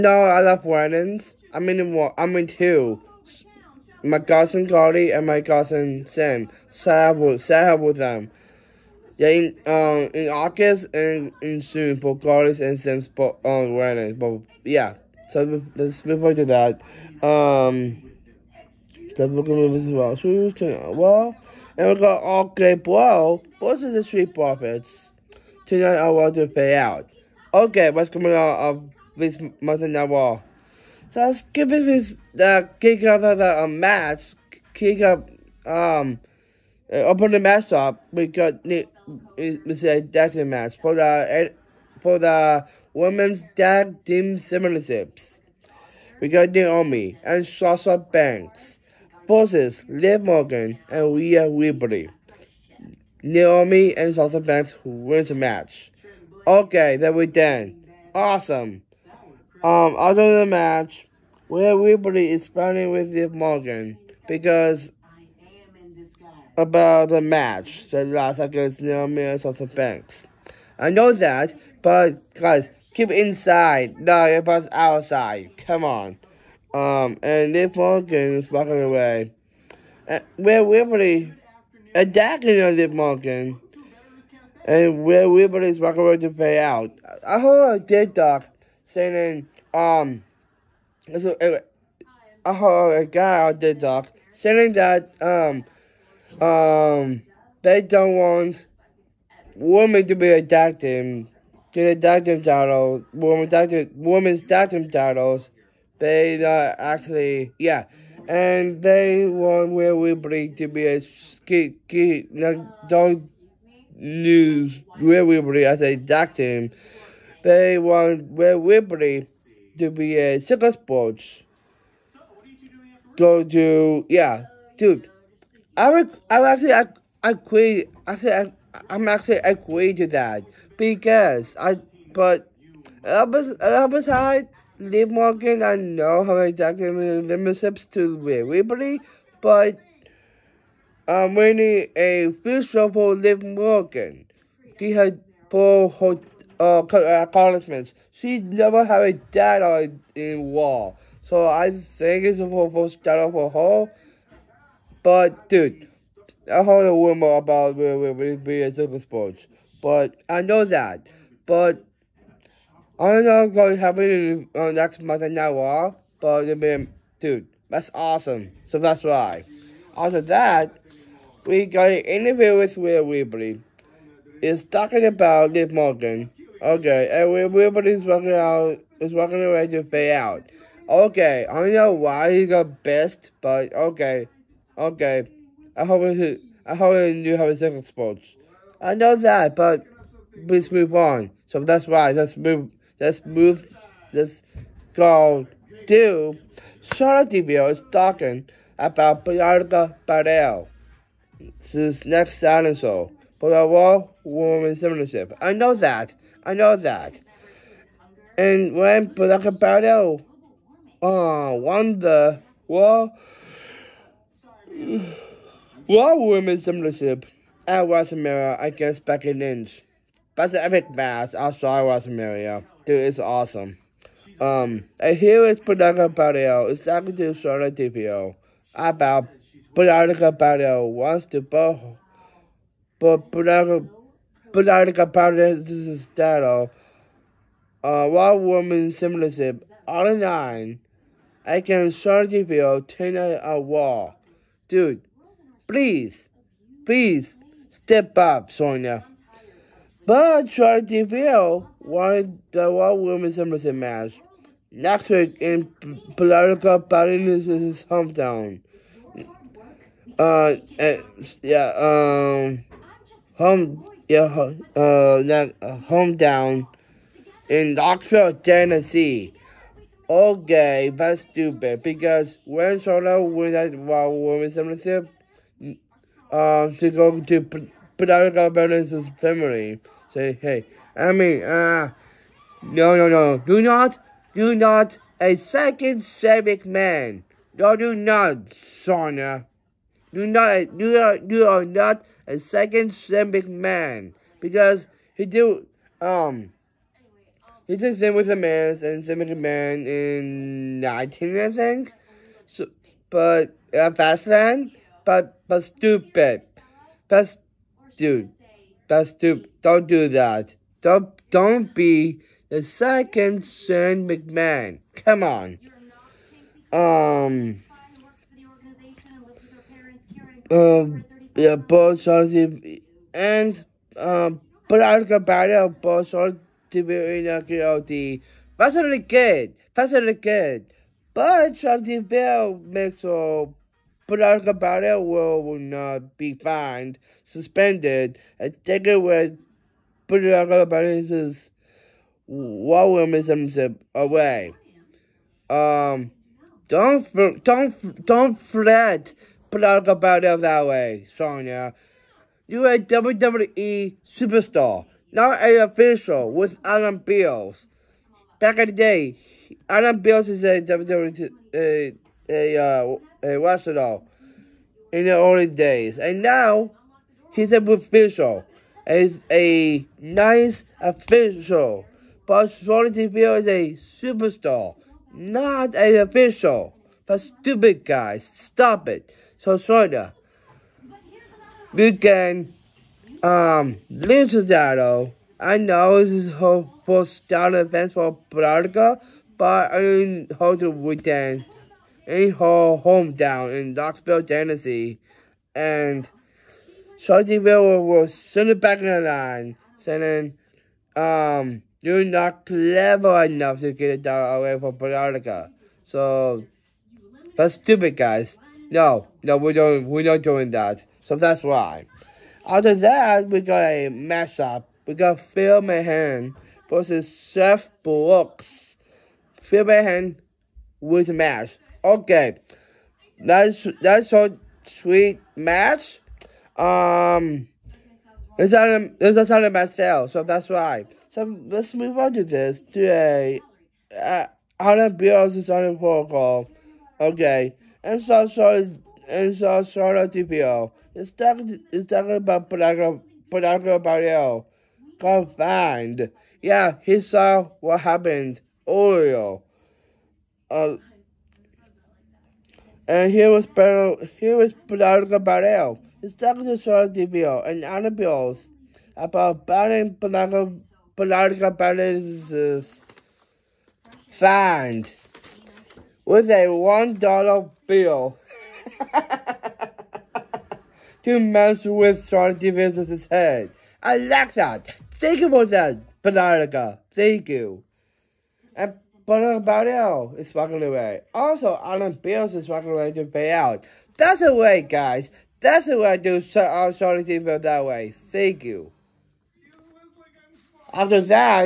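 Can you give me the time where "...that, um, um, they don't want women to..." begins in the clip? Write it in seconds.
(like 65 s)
94 s.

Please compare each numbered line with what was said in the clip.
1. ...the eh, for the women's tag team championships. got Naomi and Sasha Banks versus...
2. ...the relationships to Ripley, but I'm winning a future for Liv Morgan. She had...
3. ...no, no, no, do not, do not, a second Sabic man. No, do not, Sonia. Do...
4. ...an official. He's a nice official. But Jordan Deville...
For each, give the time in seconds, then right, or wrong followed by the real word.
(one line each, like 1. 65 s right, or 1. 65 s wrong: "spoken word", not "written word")
1. 40 s right
2. 136 s right
3. 282 s right
4. 367 s right.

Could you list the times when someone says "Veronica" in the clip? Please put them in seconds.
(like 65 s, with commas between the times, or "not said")
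388 s, 404 s.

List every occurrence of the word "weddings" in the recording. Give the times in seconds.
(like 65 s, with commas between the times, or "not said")
0 s, 13 s.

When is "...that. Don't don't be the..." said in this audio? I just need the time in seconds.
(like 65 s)
310 s.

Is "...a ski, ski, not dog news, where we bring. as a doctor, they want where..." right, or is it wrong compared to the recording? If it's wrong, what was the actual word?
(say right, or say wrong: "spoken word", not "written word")
right.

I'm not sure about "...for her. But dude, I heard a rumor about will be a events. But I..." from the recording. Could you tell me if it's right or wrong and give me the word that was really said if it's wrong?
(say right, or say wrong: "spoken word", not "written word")
wrong: "sports", not "events".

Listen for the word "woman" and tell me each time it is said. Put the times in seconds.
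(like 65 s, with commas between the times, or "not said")
103 s, 238 s.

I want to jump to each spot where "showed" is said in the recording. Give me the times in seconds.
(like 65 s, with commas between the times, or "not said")
456 s.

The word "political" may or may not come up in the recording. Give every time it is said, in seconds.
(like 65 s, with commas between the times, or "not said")
256 s.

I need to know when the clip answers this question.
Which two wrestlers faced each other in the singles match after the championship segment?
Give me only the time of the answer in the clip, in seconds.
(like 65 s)
415 s.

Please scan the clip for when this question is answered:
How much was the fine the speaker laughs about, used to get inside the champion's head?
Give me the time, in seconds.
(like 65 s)
466 s.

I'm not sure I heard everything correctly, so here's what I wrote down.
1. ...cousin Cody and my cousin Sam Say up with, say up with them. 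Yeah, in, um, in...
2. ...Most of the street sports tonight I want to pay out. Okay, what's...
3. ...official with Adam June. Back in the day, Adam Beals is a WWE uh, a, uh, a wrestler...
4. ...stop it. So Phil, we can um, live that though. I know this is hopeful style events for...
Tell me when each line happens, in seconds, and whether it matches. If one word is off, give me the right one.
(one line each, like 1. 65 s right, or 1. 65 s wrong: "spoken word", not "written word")
1. 4 s right
2. 23 s wrong: "profits", not "sports"
3. 355 s wrong: "Beals", not "June"
4. 378 s wrong: "Sonya", not "Phil".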